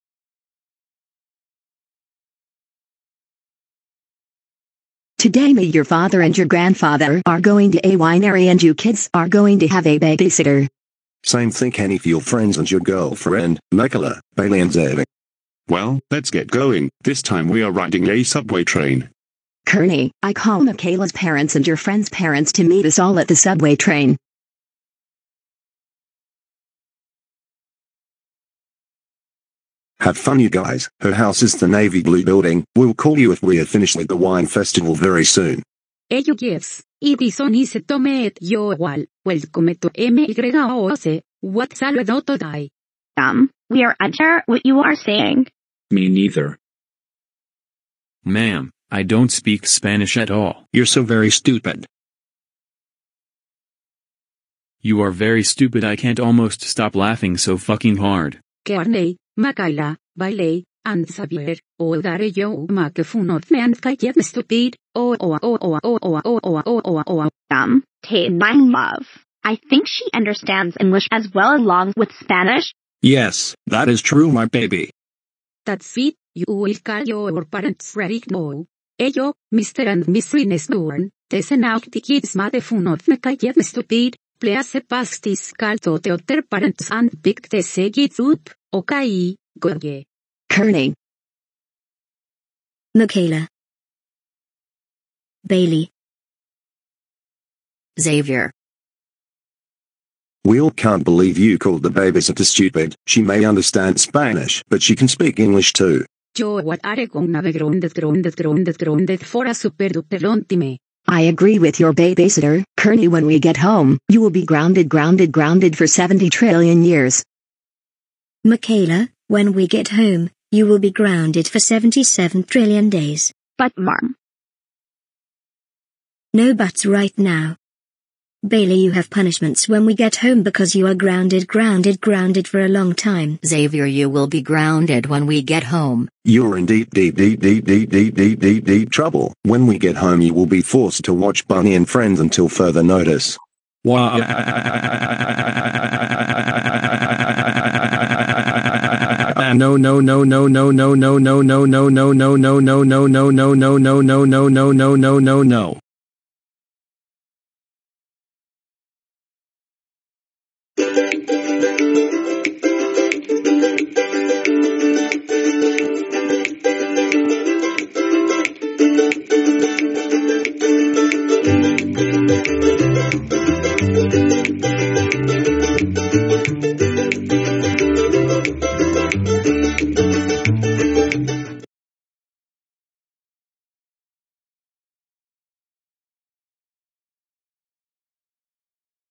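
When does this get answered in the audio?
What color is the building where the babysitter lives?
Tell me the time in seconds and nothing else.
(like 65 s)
31 s.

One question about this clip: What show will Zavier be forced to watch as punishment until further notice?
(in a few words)
Bunny and Friends.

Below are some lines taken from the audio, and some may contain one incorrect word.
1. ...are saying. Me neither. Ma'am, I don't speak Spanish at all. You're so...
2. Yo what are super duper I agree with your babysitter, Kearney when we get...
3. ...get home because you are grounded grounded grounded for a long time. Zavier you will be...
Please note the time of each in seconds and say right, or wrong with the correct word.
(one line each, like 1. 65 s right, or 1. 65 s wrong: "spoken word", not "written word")
1. 44 s right
2. 106 s right
3. 129 s right.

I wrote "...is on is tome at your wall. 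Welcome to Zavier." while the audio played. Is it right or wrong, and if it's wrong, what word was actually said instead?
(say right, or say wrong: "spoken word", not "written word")
wrong: "MYOC", not "Zavier".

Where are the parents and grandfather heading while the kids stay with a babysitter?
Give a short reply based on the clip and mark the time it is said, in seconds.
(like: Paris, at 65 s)
A winery, at 7 s.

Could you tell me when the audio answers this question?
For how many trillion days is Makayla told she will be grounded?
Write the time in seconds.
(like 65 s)
121 s.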